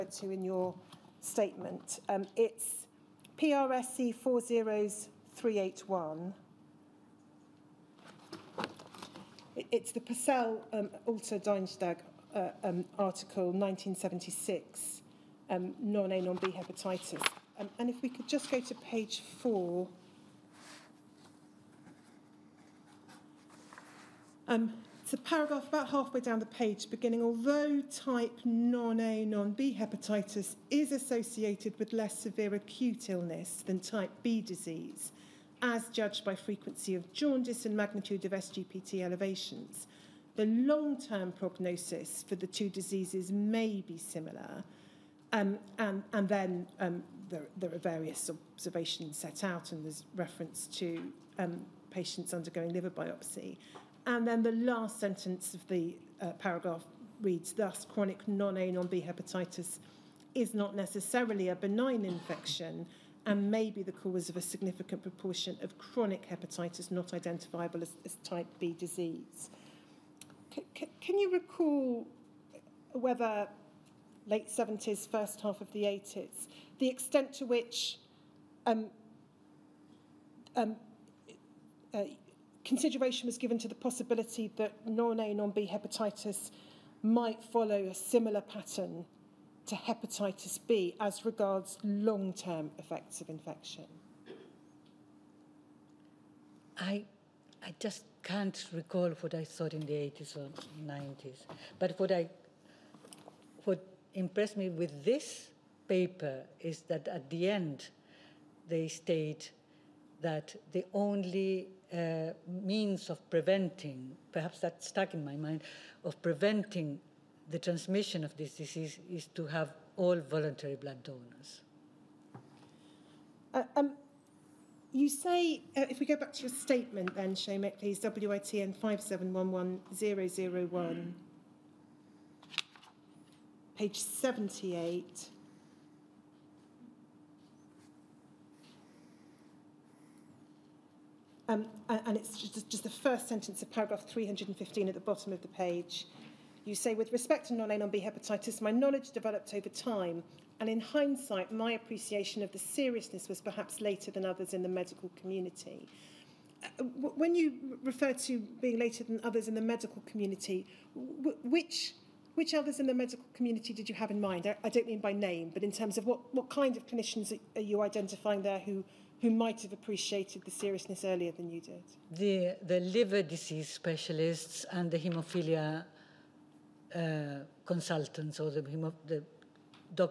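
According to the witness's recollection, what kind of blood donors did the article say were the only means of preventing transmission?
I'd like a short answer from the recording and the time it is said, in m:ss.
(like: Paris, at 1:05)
voluntary, at 2:00.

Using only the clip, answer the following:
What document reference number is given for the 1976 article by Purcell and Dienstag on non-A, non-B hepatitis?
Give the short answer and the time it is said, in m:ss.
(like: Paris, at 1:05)
PRSC 40381, at 0:03.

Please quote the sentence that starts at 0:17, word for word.
Um, and if we could just go to page four.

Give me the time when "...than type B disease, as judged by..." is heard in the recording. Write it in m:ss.
0:33.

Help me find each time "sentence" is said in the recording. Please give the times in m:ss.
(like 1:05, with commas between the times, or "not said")
0:55, 2:23.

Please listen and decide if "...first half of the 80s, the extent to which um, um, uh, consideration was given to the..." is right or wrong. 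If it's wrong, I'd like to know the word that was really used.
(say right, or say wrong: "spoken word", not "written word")
right.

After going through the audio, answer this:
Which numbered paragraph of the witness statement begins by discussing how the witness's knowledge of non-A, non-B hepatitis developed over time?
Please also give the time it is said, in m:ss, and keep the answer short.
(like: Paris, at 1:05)
315, at 2:24.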